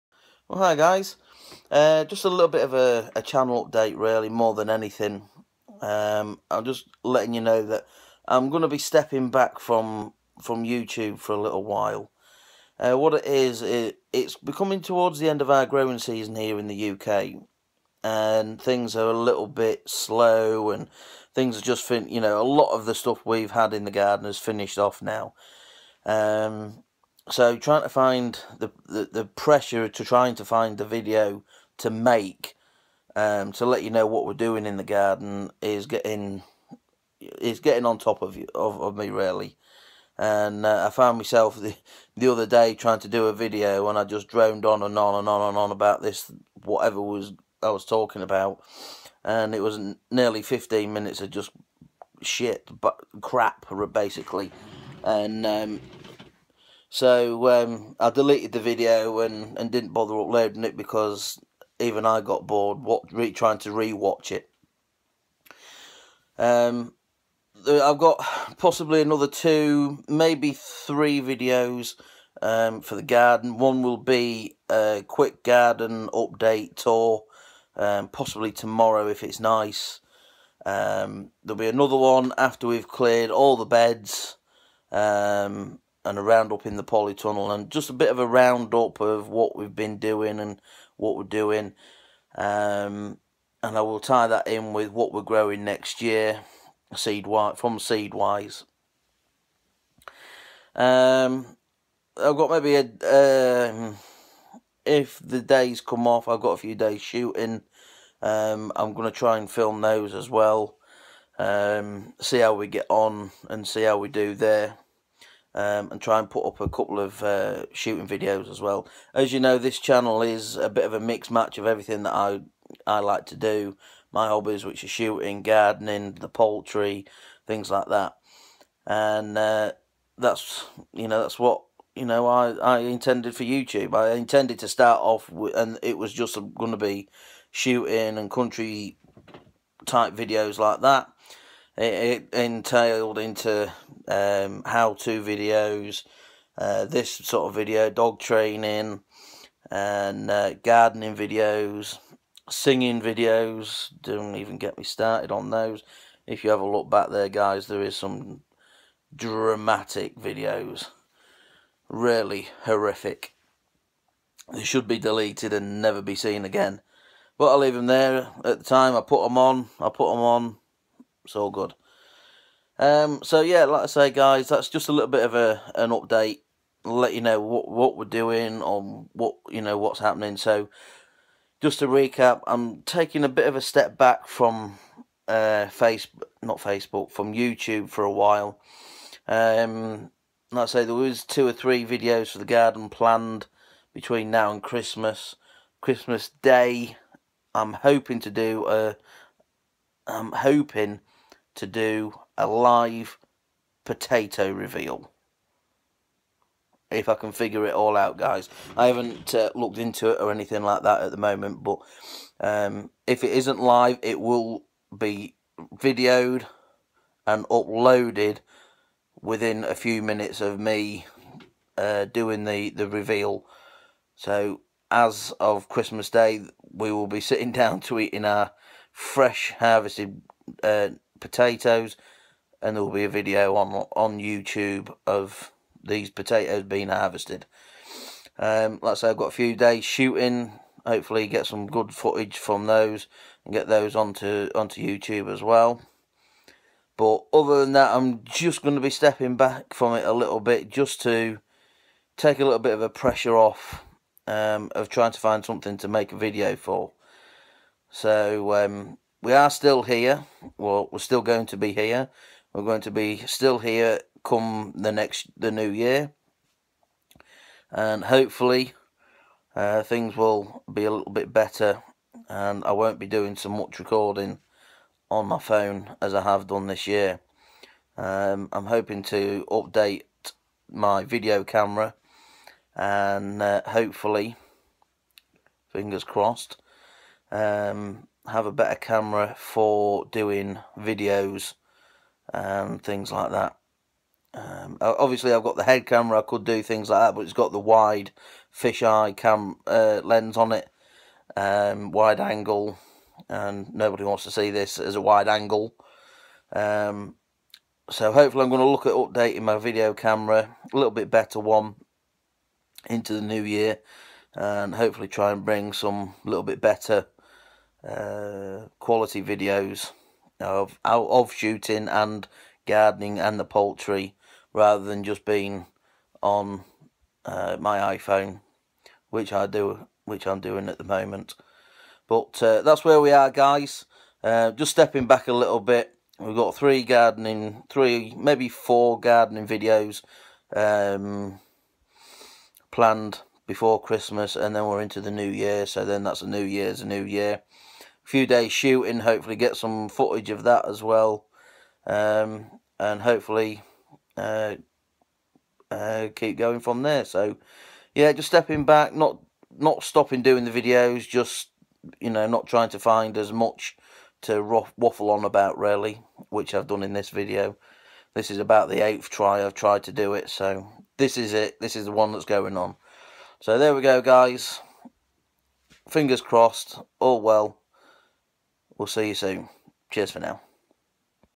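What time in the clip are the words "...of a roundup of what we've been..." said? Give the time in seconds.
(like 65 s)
88 s.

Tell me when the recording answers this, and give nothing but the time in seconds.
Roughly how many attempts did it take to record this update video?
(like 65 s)
368 s.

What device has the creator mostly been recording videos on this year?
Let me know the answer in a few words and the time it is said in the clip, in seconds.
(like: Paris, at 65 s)
iPhone, at 327 s.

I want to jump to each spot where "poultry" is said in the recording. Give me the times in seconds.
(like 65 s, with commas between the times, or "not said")
126 s, 323 s.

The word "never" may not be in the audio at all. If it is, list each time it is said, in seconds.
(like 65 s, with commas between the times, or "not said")
165 s.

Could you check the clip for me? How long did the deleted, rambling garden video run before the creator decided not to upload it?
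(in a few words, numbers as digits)
nearly 15 minutes.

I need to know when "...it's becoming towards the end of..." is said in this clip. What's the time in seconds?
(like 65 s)
14 s.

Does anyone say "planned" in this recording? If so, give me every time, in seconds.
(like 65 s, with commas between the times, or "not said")
192 s, 342 s.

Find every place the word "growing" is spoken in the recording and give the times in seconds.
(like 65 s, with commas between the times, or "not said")
15 s, 95 s.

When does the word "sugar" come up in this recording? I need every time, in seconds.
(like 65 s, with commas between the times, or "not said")
not said.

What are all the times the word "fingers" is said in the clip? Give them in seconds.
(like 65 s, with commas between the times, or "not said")
285 s, 375 s.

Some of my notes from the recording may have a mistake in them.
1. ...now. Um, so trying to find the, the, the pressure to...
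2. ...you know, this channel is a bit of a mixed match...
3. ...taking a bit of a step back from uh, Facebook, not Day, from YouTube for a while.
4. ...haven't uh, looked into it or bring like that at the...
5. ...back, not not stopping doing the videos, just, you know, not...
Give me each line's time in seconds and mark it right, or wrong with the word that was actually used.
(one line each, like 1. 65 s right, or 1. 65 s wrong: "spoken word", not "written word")
1. 25 s right
2. 119 s right
3. 182 s wrong: "Facebook", not "Day"
4. 208 s wrong: "anything", not "bring"
5. 358 s right.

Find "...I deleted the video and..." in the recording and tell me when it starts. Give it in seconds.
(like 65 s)
58 s.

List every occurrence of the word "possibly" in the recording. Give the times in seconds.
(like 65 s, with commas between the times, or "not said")
68 s, 78 s.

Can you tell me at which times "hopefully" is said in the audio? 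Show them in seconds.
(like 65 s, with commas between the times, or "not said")
240 s, 268 s, 283 s, 308 s, 314 s, 349 s, 353 s.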